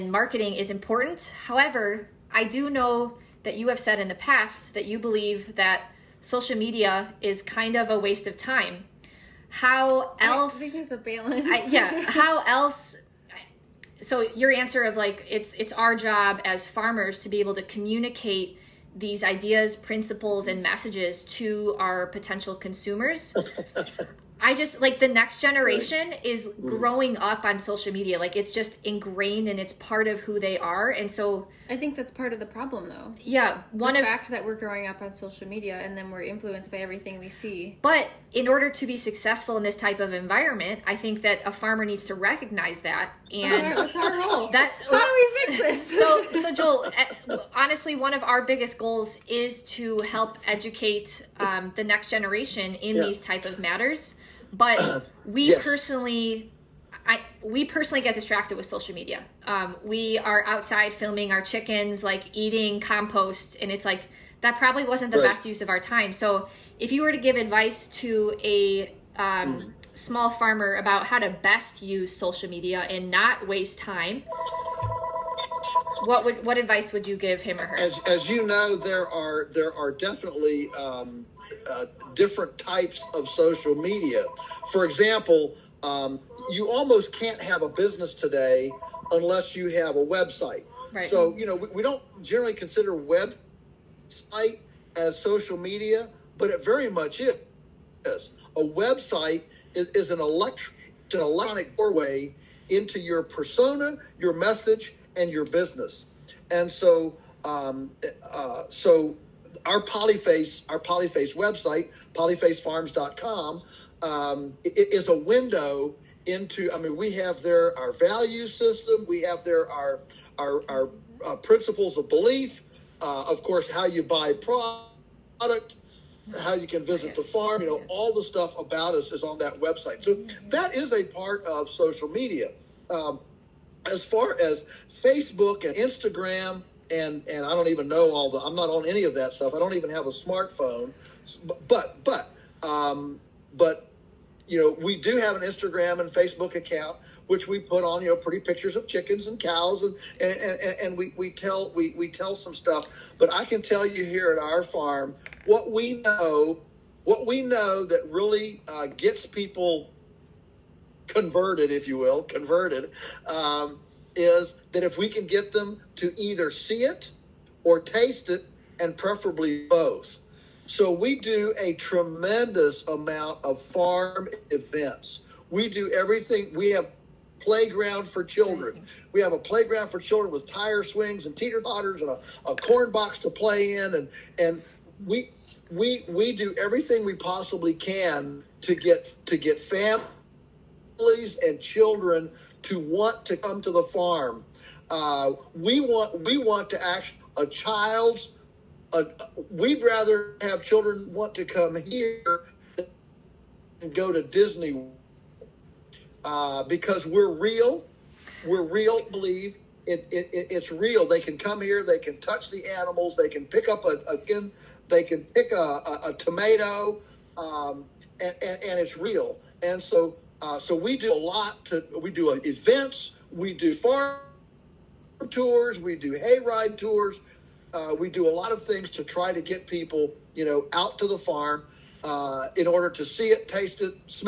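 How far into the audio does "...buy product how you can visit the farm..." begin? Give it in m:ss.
2:04.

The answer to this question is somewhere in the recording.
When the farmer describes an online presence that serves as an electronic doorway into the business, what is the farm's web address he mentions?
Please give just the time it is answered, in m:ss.
1:52.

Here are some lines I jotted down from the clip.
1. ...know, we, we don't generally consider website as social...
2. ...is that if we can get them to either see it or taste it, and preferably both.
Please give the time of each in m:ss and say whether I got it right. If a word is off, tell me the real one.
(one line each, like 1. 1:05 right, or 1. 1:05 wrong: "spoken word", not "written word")
1. 1:31 right
2. 2:44 right.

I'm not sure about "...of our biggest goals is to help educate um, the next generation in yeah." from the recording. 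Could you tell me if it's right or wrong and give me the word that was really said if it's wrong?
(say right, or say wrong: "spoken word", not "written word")
right.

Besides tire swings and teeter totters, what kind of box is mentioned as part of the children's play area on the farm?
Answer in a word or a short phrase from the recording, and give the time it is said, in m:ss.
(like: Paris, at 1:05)
corn box, at 3:02.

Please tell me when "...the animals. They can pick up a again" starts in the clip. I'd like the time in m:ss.
3:32.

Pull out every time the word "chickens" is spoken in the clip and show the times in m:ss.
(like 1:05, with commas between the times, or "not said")
1:01, 2:28.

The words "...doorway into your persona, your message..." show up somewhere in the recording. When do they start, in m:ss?
1:41.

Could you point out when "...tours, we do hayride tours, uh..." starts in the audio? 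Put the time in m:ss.
3:45.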